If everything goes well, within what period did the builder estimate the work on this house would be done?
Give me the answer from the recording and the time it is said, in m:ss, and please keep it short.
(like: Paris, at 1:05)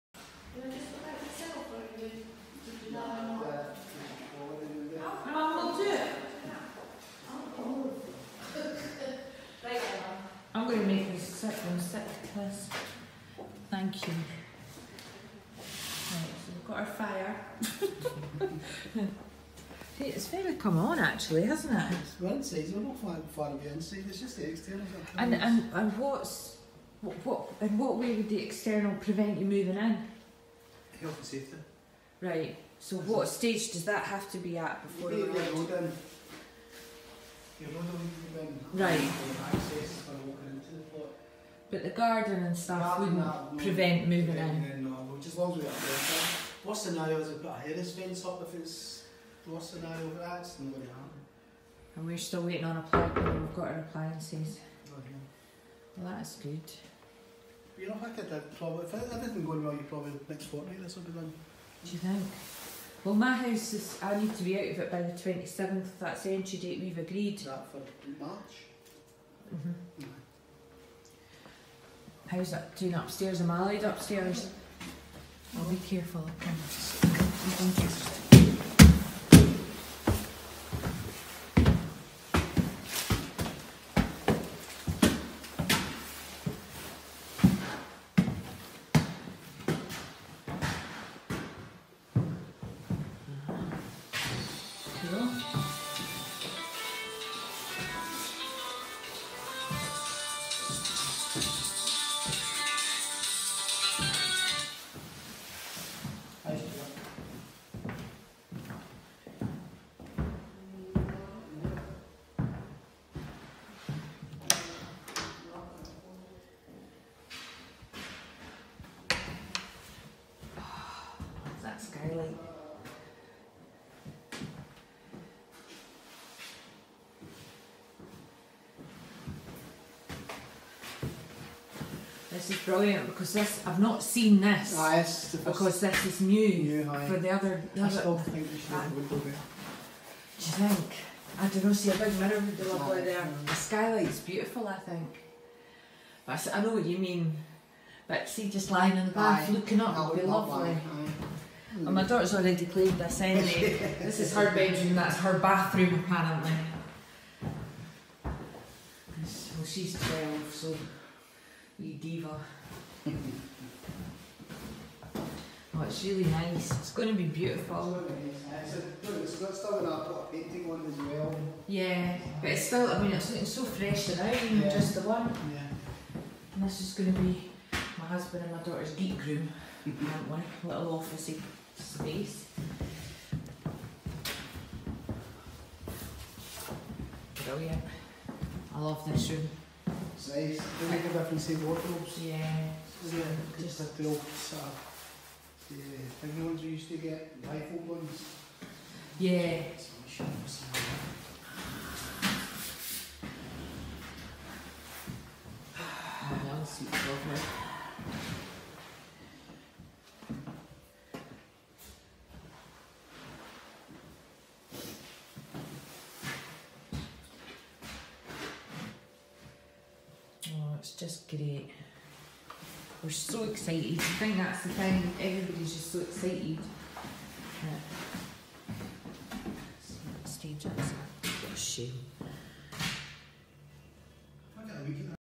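Next fortnight, at 1:00.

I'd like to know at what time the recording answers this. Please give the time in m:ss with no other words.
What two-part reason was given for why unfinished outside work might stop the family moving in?
0:31.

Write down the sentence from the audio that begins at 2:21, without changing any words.
See a big mirror would be ah, lovely there.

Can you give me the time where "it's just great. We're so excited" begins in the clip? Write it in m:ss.
3:40.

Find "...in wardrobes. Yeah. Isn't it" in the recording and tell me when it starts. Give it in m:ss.
3:11.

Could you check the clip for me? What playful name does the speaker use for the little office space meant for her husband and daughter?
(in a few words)
Geek room.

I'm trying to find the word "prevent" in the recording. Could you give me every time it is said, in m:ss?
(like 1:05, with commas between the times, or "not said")
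0:28, 0:43.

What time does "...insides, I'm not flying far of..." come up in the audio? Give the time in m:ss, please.
0:22.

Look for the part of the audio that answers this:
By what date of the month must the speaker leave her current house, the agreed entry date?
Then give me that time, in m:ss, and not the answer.
1:05.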